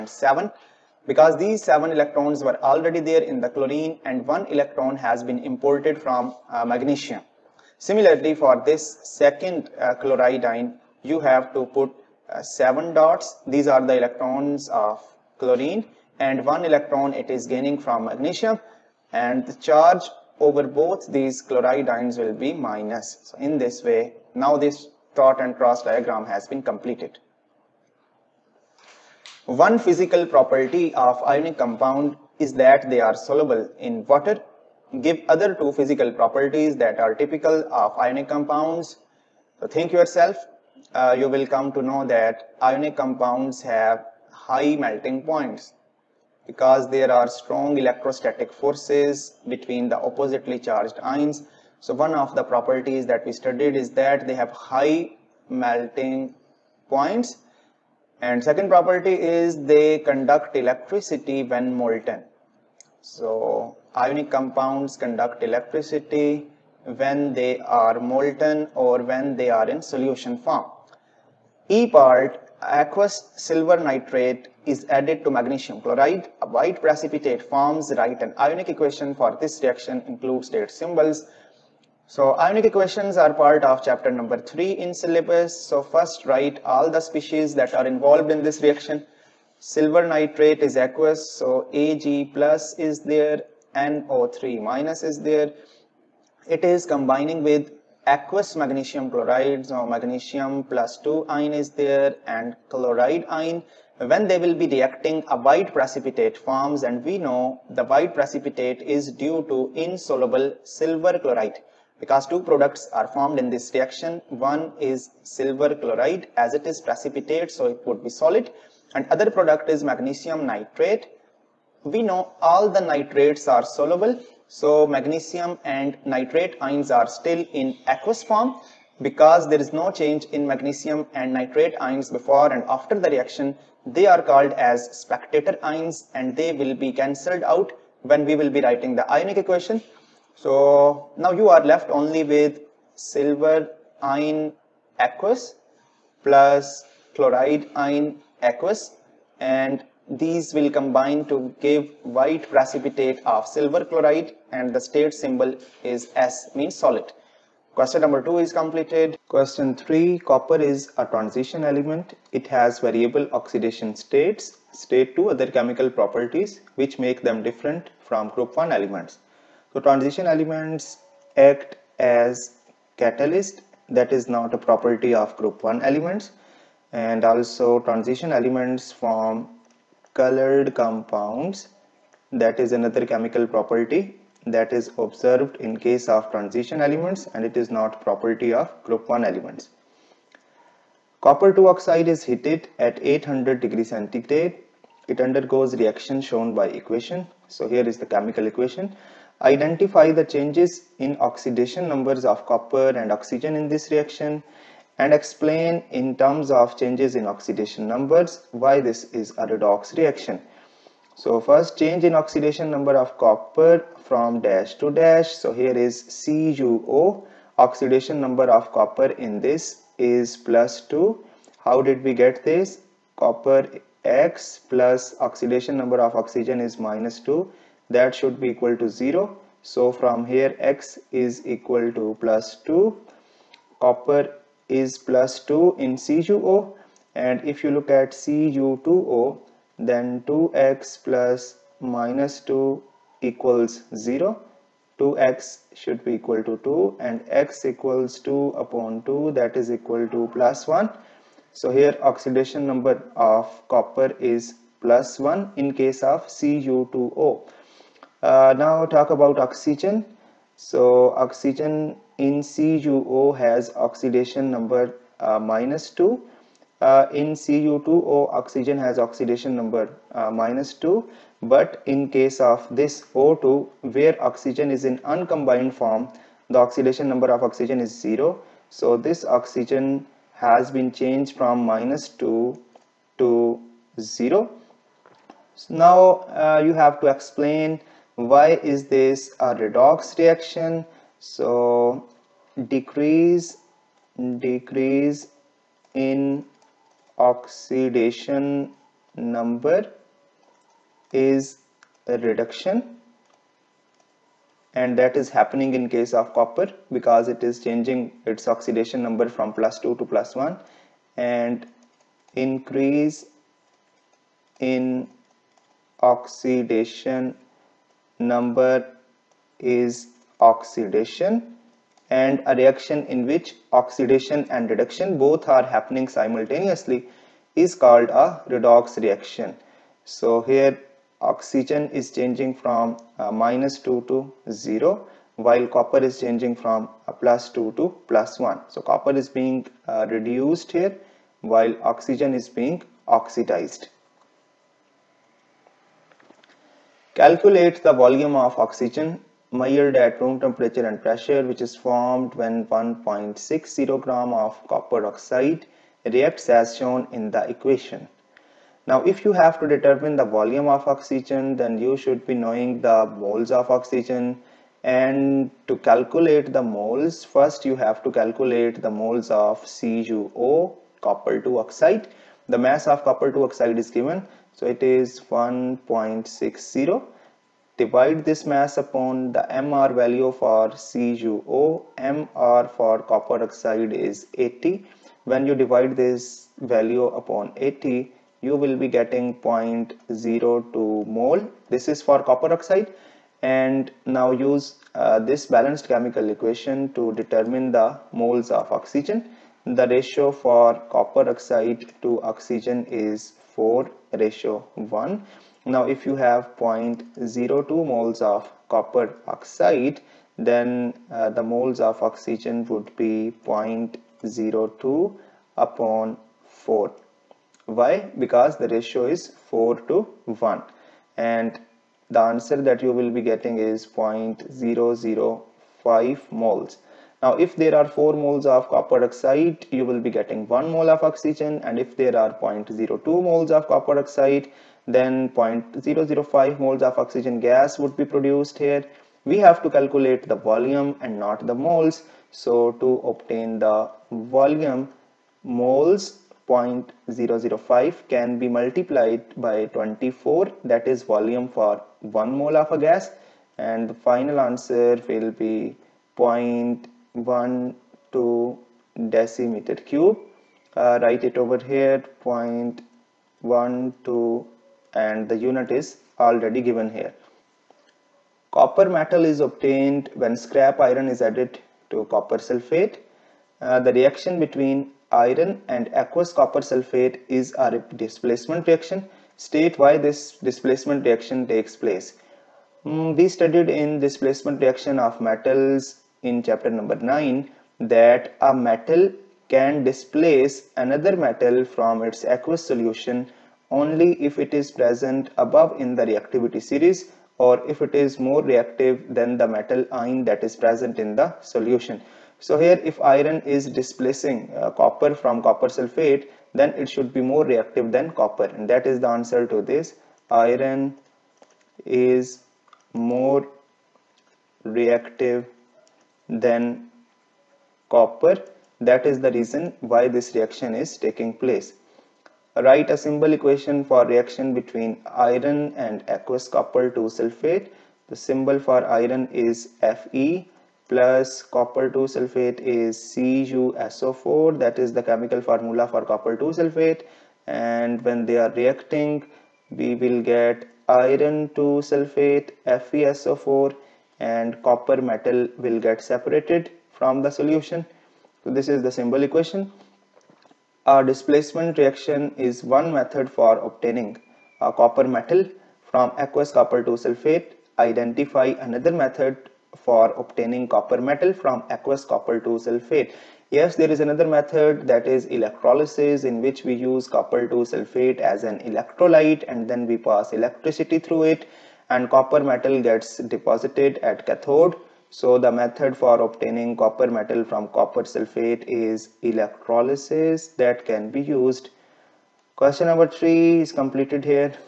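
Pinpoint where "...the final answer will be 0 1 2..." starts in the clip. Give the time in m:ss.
7:33.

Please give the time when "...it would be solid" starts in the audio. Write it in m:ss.
1:57.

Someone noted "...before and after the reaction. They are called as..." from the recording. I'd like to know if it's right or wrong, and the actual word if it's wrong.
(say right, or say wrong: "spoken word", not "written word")
right.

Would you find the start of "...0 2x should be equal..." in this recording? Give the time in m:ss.
4:03.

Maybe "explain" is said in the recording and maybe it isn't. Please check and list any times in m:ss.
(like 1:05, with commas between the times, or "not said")
3:25, 4:47.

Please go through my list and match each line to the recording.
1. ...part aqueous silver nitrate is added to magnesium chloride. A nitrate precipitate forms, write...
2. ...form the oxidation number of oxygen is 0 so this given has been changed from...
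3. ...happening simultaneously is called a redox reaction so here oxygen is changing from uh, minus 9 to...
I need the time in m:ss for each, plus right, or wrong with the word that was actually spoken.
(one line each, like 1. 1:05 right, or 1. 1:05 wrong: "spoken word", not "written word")
1. 1:11 wrong: "white", not "nitrate"
2. 4:35 wrong: "oxygen", not "given"
3. 5:25 wrong: "2", not "9".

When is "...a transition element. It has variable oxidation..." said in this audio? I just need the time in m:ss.
2:40.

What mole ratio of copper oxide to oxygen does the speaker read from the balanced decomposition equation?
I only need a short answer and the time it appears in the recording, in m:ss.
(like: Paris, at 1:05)
4:1, at 6:43.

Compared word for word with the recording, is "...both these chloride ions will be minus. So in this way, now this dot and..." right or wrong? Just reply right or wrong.
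right.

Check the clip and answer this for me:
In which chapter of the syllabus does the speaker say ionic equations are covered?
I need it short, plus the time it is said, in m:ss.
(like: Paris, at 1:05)
3, at 1:23.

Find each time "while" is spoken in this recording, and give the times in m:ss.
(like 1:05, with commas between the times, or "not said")
5:35, 5:41.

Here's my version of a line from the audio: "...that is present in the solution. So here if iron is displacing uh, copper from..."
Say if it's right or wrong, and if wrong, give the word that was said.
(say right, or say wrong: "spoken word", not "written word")
right.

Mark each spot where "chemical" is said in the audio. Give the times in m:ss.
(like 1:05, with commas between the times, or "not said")
2:45, 3:03, 3:18, 6:35, 8:55.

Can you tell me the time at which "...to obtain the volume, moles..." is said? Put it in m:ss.
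7:22.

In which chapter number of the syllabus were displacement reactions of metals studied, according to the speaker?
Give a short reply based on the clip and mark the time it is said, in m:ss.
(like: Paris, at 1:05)
9, at 8:06.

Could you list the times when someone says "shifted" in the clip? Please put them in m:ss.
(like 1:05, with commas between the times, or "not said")
not said.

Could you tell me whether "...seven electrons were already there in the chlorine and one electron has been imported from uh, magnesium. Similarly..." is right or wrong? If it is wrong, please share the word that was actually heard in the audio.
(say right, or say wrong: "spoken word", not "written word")
right.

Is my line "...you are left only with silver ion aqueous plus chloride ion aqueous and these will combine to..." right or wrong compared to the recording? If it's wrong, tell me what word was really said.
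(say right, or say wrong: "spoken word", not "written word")
right.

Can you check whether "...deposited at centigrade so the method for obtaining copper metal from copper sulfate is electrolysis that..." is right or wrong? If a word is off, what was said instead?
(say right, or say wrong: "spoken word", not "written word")
wrong: "cathode", not "centigrade".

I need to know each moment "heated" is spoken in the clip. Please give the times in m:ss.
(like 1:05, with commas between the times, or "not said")
3:12.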